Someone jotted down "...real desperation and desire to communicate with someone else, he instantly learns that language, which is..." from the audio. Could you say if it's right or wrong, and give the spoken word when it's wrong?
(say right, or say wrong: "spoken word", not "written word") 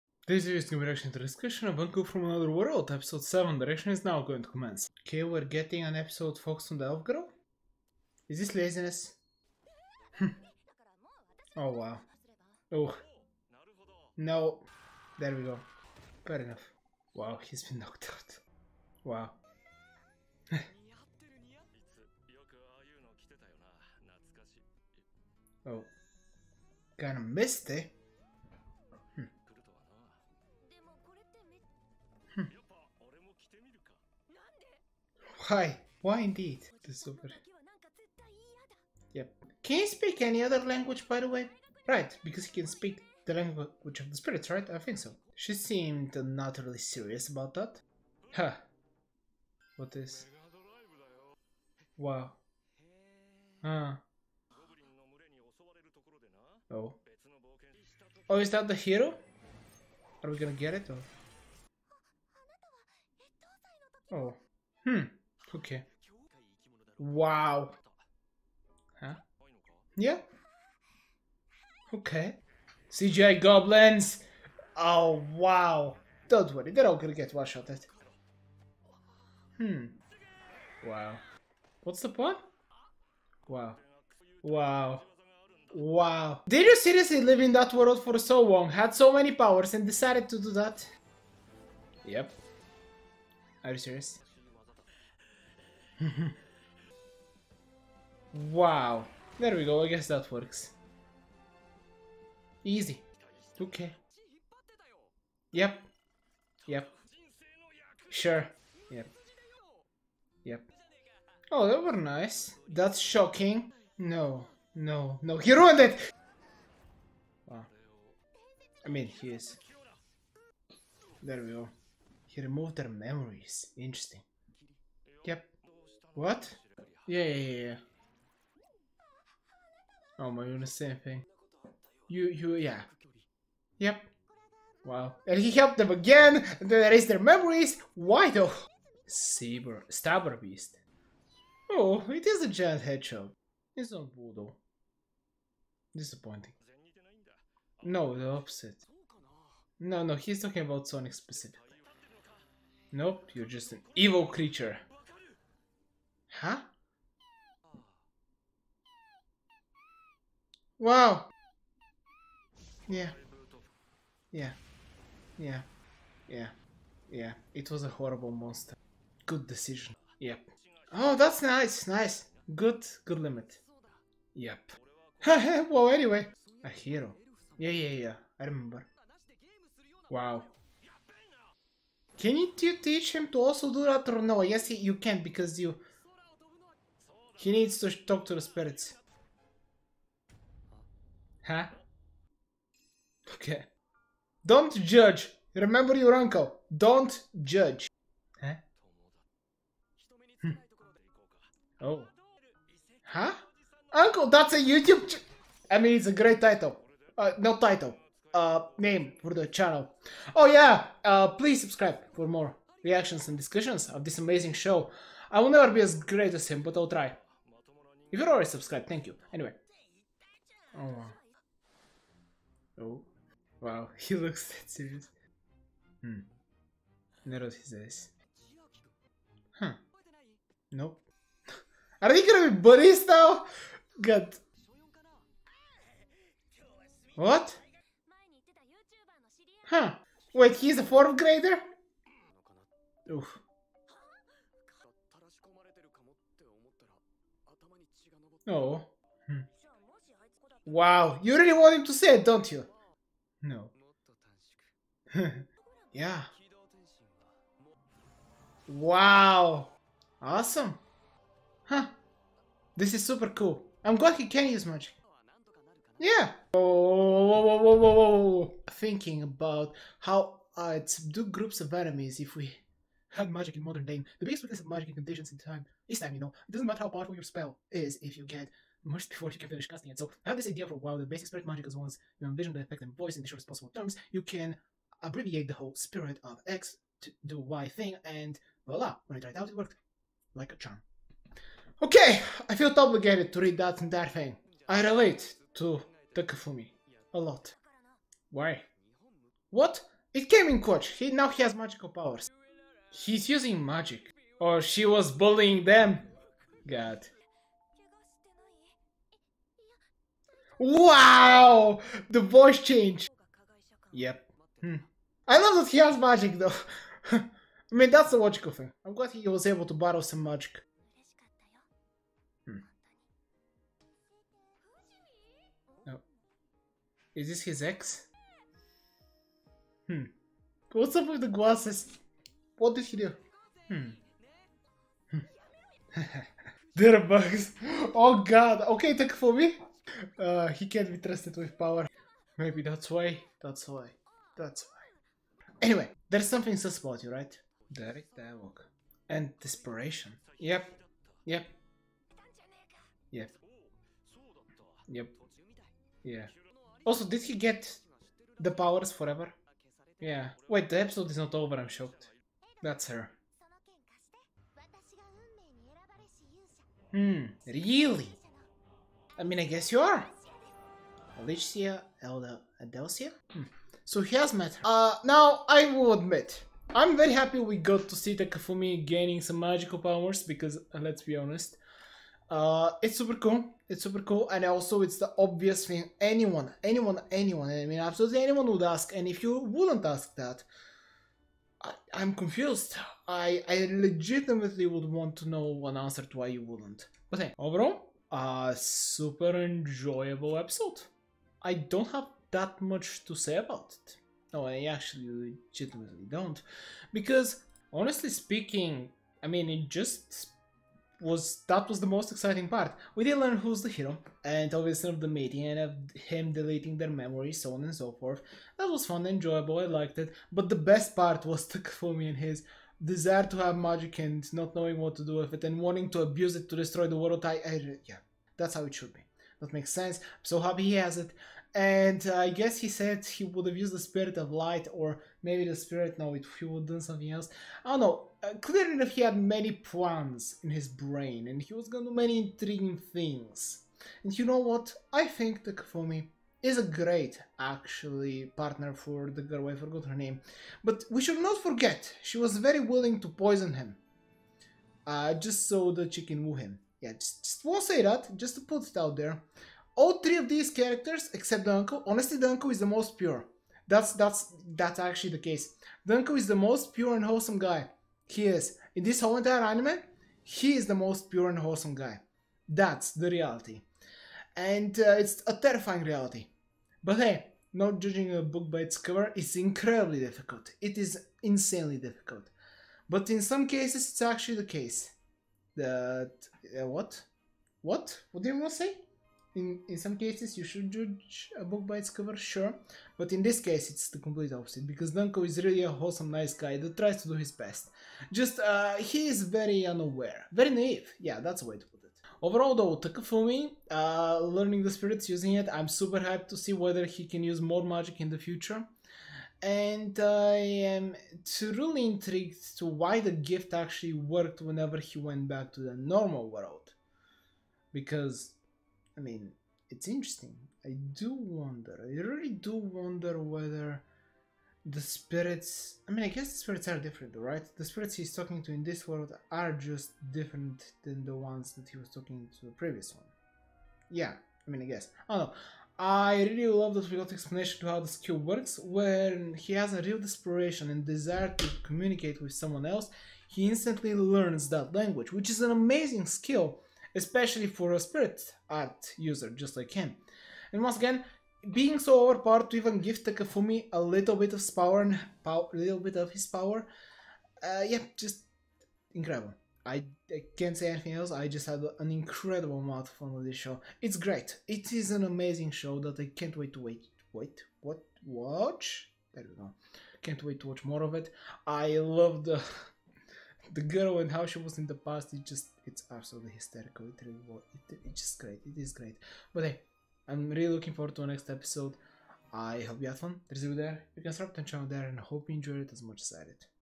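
right.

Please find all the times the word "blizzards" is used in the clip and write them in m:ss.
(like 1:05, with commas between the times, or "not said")
not said.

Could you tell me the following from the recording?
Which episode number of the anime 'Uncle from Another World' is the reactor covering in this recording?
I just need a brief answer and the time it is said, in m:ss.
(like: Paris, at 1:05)
7, at 0:02.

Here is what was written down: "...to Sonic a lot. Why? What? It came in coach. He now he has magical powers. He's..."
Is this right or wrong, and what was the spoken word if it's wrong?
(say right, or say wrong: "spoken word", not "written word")
wrong: "Takafumi", not "Sonic".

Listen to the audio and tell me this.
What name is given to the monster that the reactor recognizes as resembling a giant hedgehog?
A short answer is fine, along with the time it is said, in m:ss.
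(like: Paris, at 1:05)
Saber Stabber Beast, at 2:19.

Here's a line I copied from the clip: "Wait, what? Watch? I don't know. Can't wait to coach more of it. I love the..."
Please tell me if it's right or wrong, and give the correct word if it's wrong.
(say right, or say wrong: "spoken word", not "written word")
wrong: "watch", not "coach".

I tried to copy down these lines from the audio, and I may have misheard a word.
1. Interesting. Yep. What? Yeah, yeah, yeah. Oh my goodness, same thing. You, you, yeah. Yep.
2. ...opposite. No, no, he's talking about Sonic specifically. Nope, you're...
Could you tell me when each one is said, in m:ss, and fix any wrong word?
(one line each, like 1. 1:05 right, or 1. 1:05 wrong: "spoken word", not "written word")
1. 2:03 right
2. 2:28 right.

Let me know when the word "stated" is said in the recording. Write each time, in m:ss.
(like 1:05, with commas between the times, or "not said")
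not said.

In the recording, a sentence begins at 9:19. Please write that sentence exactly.
I, I, can't say anything else.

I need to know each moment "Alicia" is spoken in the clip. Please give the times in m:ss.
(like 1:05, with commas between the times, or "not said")
6:11.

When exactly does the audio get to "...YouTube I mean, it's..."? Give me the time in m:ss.
3:24.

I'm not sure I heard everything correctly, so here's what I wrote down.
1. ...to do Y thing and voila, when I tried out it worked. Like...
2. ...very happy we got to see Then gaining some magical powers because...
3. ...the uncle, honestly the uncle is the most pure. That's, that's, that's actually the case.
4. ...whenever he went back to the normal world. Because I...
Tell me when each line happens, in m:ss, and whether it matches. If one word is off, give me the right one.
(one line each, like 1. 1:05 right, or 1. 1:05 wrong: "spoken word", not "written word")
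1. 4:47 right
2. 6:16 wrong: "Takafumi", not "Then"
3. 7:41 right
4. 8:34 right.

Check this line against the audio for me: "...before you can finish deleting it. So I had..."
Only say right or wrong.
wrong.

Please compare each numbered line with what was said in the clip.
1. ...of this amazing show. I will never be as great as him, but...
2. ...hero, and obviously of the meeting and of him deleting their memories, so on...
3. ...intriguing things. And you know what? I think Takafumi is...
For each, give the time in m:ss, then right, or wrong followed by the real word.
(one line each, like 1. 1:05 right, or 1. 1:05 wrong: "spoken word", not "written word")
1. 3:33 right
2. 6:53 right
3. 7:22 right.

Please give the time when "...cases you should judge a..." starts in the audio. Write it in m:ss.
8:09.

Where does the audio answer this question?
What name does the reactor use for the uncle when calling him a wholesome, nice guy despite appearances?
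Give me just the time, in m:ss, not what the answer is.
8:14.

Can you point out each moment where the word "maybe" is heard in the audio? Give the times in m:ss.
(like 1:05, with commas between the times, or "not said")
5:42, 7:15.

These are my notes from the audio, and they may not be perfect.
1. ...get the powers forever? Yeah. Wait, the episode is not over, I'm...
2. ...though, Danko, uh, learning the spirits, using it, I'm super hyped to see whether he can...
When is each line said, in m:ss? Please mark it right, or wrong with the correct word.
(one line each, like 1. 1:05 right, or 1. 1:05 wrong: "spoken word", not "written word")
1. 5:57 right
2. 8:22 wrong: "Takafumi", not "Danko".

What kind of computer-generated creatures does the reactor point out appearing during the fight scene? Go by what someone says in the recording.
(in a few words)
Goblins.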